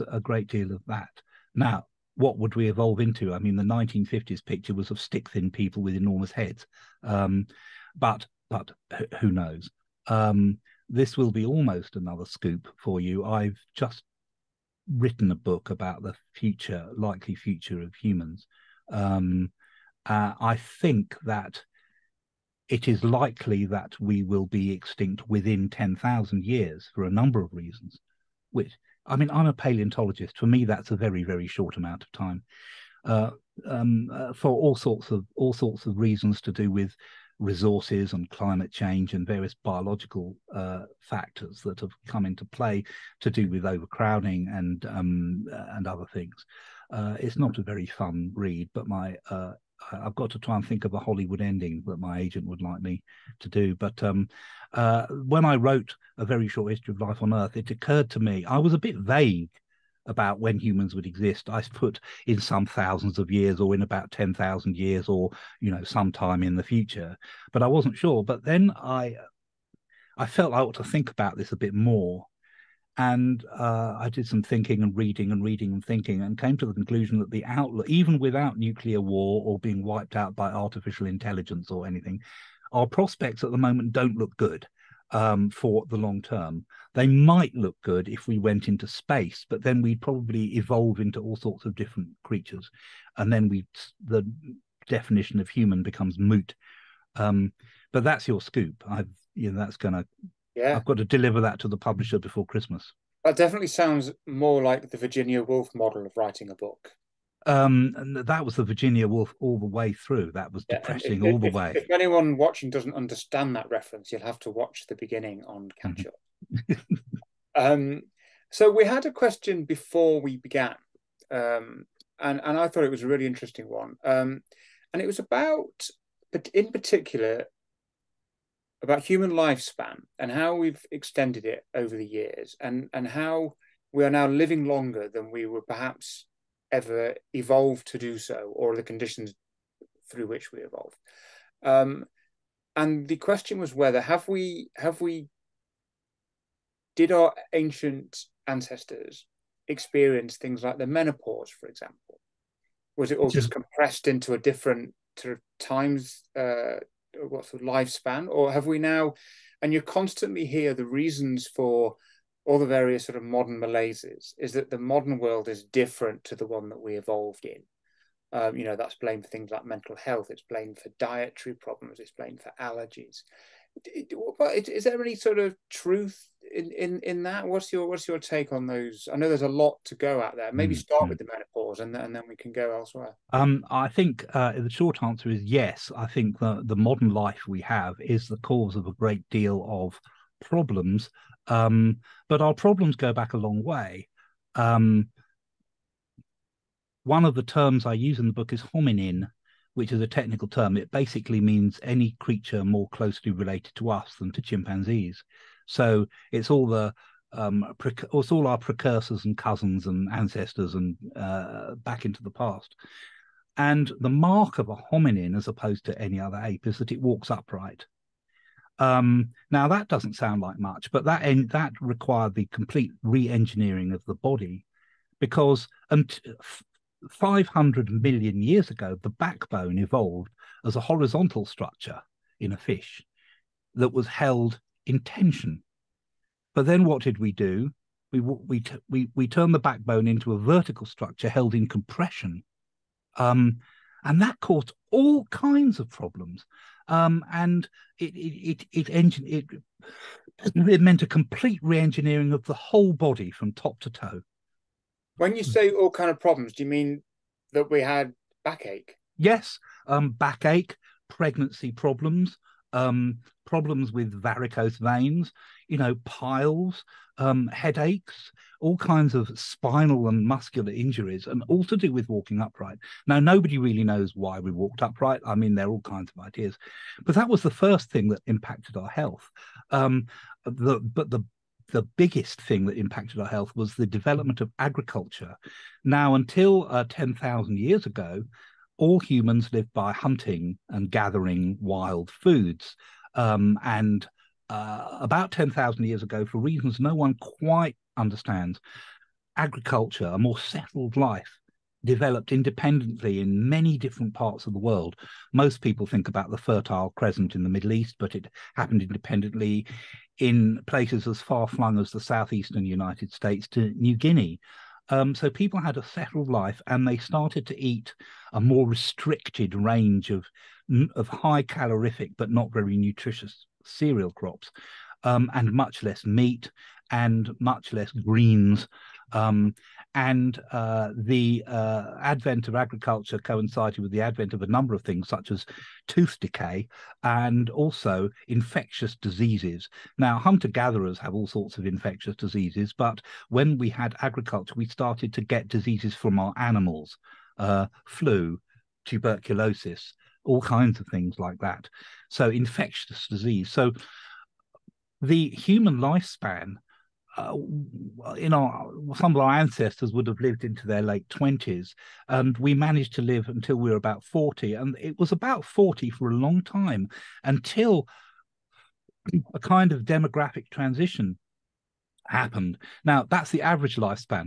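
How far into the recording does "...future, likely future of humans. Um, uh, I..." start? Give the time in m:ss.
0:16.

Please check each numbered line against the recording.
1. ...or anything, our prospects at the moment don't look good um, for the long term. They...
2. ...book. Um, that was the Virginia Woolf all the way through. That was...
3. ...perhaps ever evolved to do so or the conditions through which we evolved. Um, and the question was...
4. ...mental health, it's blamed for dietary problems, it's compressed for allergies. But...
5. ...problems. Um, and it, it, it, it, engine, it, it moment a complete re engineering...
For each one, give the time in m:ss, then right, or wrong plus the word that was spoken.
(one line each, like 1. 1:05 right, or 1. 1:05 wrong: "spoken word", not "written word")
1. 1:21 right
2. 1:46 right
3. 2:15 right
4. 2:49 wrong: "blamed", not "compressed"
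5. 4:05 wrong: "meant", not "moment".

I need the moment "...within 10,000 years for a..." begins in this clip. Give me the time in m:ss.
0:25.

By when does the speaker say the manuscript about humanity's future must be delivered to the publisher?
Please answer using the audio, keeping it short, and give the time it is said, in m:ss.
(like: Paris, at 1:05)
Before Christmas, at 1:42.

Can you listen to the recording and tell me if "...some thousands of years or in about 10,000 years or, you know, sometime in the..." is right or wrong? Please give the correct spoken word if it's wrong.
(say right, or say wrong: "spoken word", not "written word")
right.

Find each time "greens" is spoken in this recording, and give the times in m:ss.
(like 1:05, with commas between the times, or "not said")
5:27.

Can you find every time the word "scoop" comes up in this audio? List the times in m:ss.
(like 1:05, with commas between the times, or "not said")
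0:12, 1:38.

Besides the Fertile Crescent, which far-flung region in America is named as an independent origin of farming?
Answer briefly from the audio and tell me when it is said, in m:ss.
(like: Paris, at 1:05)
southeastern United States, at 5:12.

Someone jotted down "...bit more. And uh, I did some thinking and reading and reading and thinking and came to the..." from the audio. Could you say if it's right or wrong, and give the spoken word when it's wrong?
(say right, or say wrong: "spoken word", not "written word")
right.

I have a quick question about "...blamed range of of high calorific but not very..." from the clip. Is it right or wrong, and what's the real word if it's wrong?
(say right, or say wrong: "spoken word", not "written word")
wrong: "restricted", not "blamed".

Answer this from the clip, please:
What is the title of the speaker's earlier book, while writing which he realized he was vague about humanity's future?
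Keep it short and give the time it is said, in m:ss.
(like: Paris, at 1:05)
A Very Short History of Life on Earth, at 0:56.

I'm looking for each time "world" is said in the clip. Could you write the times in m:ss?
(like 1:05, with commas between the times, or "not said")
2:45, 5:04.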